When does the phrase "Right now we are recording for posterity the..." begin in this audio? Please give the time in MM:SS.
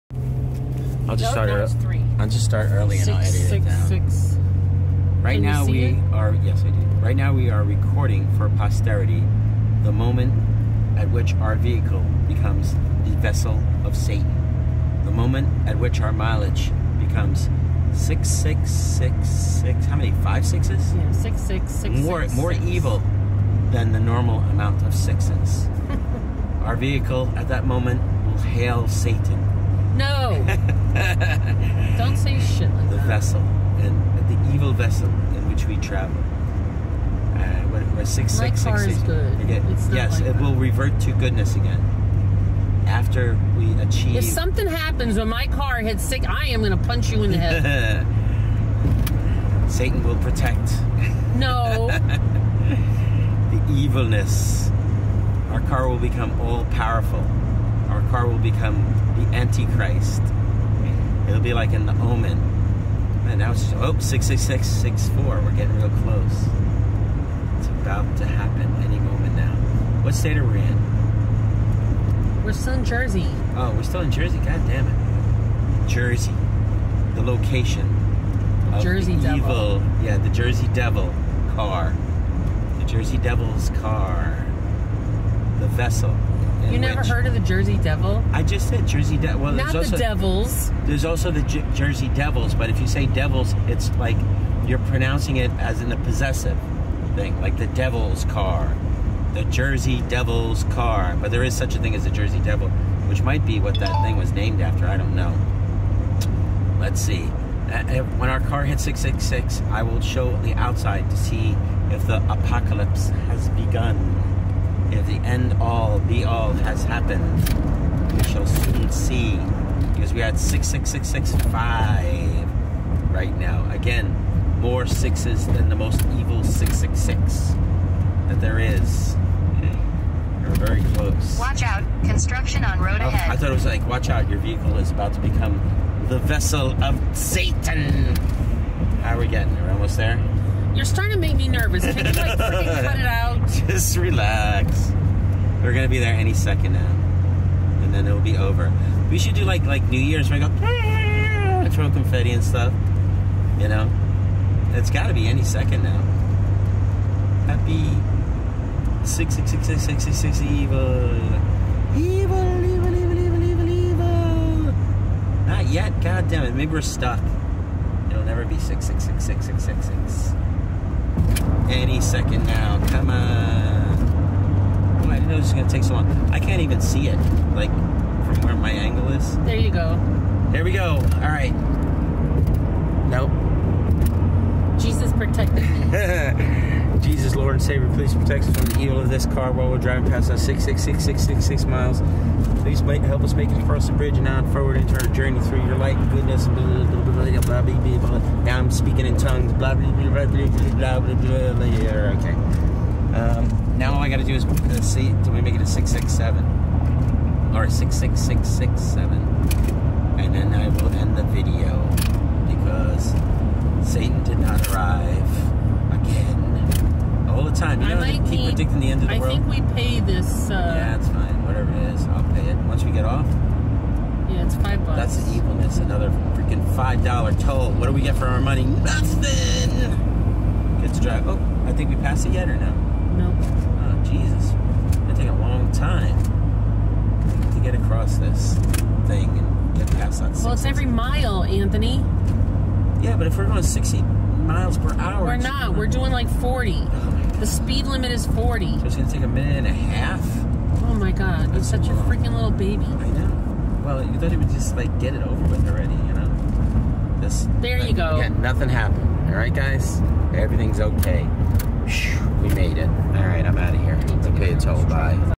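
00:07.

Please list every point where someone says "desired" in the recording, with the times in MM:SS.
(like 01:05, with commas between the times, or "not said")
not said.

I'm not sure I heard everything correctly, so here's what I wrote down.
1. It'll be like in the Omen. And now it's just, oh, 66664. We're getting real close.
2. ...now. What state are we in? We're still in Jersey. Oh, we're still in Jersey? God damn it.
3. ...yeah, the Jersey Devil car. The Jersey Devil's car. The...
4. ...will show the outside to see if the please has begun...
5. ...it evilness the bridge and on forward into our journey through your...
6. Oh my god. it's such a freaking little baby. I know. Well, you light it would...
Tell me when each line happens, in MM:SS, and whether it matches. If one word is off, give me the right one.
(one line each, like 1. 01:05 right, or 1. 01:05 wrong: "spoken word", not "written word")
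1. 01:01 right
2. 01:09 right
3. 01:20 right
4. 01:49 wrong: "apocalypse", not "please"
5. 03:13 wrong: "across", not "evilness"
6. 04:10 wrong: "thought", not "light".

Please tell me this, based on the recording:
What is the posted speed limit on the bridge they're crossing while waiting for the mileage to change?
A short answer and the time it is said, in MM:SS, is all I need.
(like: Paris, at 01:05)
40, at 04:07.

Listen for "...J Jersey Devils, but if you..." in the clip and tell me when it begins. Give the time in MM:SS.
01:31.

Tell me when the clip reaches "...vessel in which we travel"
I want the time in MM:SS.
00:34.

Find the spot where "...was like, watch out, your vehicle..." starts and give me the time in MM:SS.
02:13.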